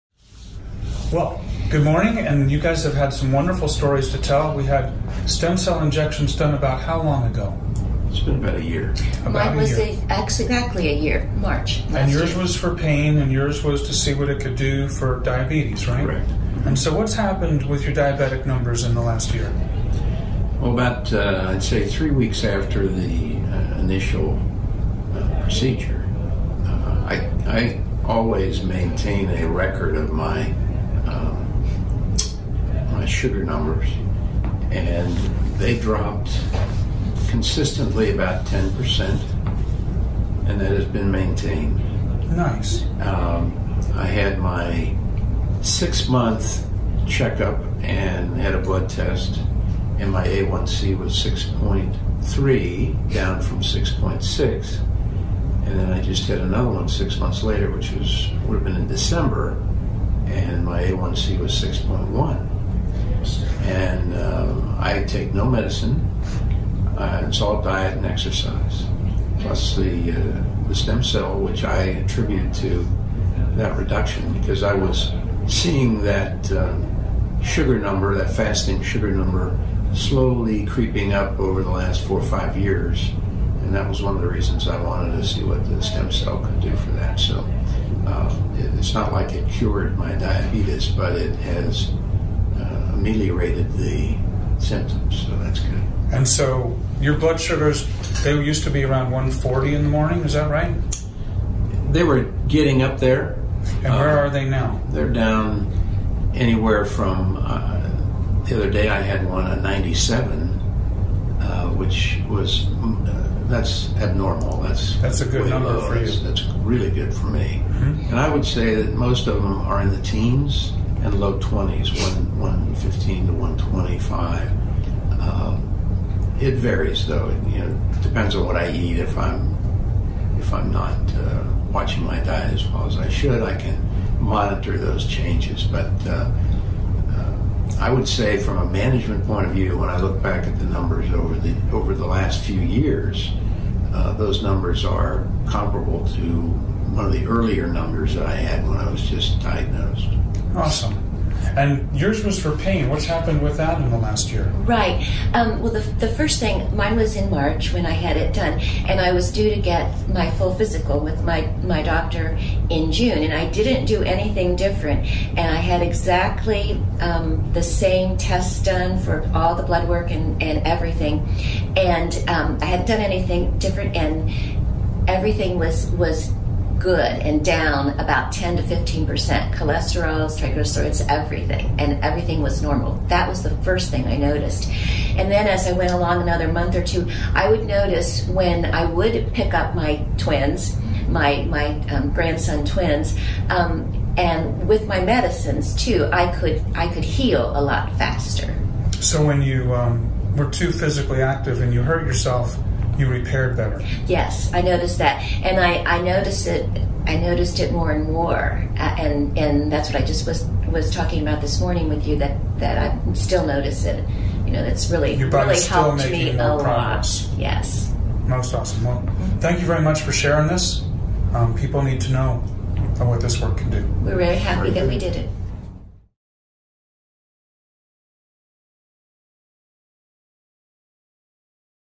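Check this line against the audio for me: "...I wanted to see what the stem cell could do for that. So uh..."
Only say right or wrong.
right.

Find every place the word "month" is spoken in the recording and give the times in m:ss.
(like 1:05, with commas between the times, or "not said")
0:46, 0:57, 3:06.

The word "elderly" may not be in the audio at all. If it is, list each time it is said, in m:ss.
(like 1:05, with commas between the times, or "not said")
not said.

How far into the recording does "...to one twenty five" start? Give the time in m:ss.
2:03.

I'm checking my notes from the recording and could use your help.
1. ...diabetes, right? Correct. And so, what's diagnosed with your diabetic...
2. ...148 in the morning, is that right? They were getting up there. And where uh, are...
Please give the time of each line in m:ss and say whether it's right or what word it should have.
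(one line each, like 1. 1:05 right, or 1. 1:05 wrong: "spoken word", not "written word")
1. 0:15 wrong: "happened", not "diagnosed"
2. 1:39 wrong: "140", not "148".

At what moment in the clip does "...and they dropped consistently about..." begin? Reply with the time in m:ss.
0:34.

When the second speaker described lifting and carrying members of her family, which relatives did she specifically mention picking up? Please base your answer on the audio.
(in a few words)
grandson twins.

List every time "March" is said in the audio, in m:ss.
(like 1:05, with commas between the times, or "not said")
0:11, 2:37.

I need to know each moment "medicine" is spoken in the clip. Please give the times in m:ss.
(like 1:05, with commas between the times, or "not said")
1:05, 3:15.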